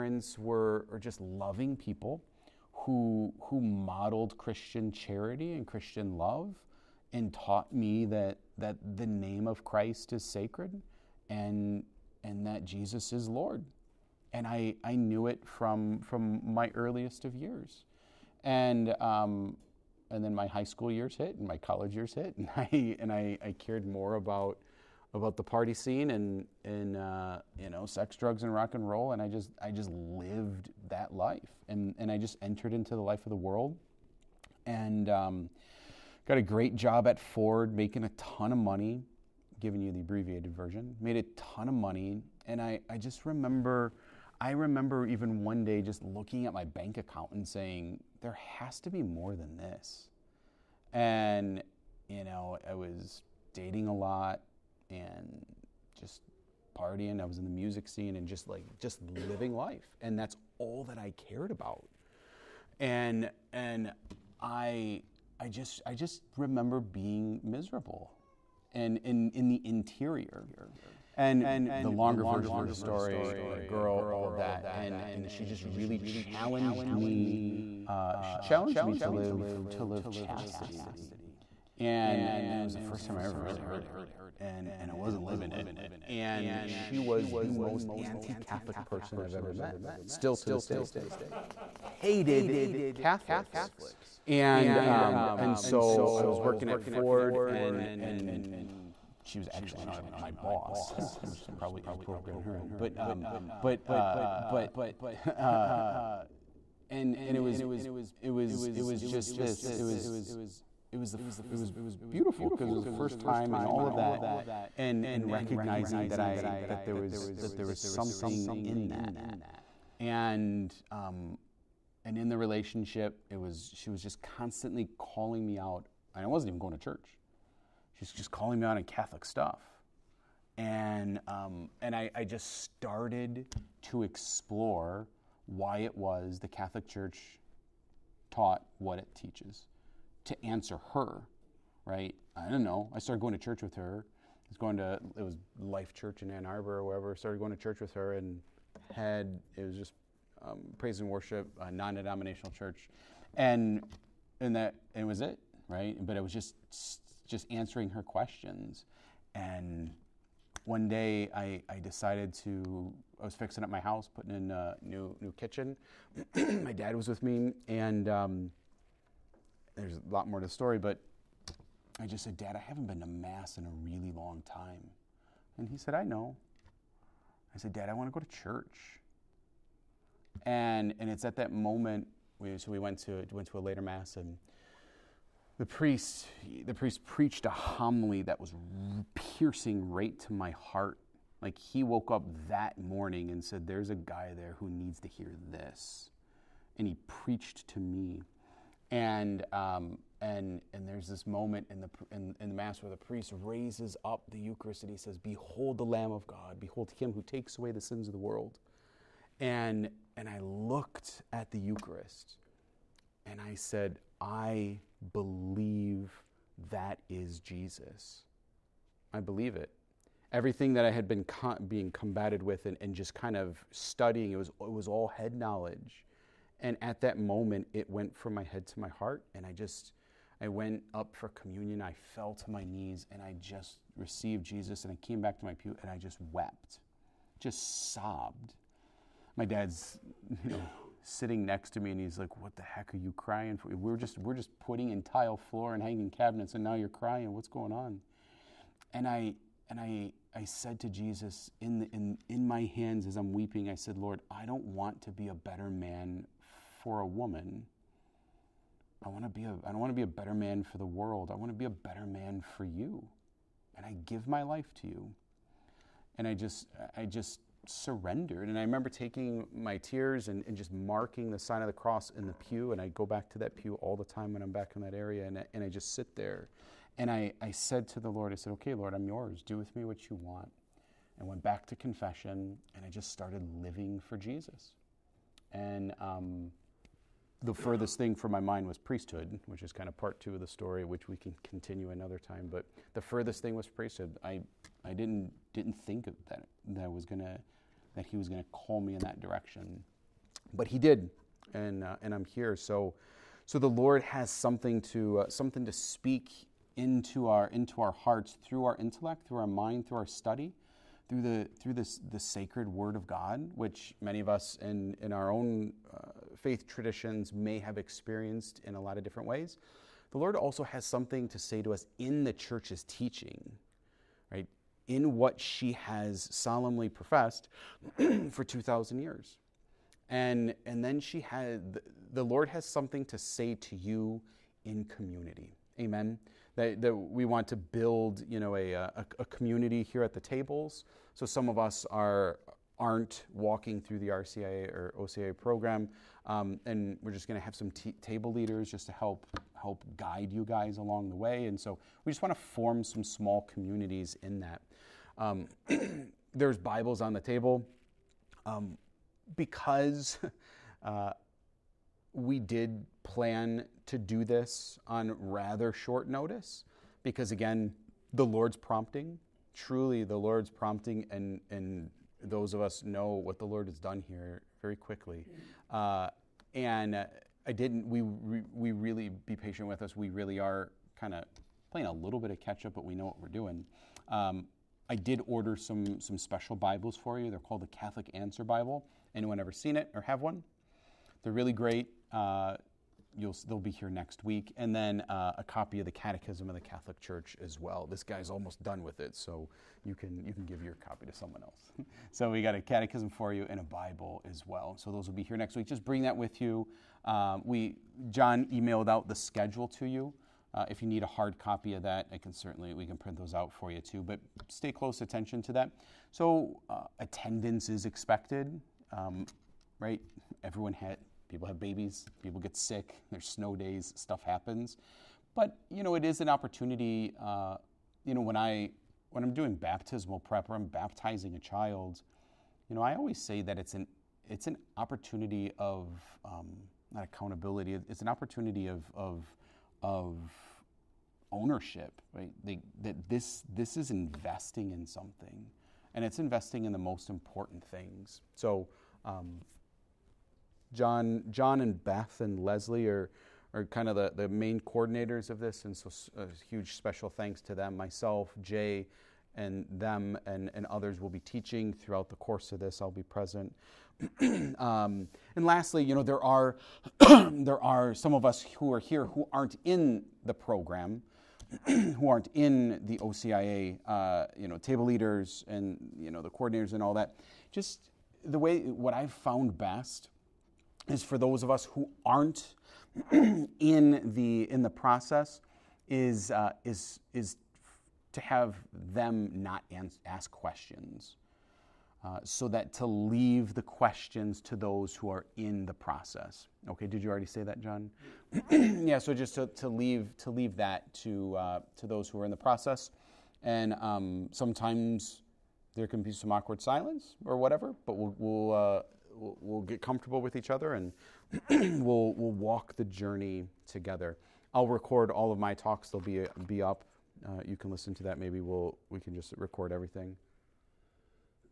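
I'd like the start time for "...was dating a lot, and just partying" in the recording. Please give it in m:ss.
0:52.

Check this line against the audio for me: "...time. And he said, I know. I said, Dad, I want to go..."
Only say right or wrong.
right.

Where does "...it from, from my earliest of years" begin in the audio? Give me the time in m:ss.
0:15.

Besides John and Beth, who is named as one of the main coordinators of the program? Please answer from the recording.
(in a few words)
Leslie.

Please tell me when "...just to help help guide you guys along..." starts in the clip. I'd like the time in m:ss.
5:48.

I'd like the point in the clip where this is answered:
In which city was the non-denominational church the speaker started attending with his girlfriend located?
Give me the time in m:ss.
2:26.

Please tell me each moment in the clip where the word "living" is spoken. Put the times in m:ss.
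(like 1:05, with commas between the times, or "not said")
0:59, 1:25, 4:43.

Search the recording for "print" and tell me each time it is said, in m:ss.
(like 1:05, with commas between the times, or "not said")
6:52.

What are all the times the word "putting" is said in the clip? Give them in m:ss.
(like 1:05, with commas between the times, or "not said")
2:44, 4:04.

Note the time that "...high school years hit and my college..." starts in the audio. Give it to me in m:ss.
0:20.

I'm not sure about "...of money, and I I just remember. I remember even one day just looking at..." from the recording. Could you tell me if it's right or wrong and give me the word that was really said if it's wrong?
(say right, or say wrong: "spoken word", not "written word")
right.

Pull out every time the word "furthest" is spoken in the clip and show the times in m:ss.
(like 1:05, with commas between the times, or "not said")
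4:47, 4:53.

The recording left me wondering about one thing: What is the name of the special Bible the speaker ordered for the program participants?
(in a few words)
Catholic Answer Bible.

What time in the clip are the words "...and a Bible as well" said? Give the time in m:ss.
6:43.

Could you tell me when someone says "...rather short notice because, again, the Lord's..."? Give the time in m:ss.
6:05.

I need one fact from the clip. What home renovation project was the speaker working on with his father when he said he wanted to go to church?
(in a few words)
new kitchen.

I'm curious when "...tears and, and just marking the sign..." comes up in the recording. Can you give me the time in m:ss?
4:29.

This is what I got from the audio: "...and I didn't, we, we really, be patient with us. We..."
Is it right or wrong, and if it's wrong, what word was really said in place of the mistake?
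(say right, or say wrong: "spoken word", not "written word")
right.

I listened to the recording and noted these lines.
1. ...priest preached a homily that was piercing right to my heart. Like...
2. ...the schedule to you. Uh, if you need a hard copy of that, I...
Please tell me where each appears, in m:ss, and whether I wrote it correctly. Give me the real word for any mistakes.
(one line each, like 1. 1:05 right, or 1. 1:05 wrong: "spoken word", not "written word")
1. 3:06 right
2. 6:49 right.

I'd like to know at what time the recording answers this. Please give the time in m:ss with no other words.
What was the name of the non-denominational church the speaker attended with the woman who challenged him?
2:25.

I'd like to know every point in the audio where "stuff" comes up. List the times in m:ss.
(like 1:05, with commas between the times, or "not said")
2:09, 7:03.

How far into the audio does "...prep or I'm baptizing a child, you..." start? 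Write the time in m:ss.
7:10.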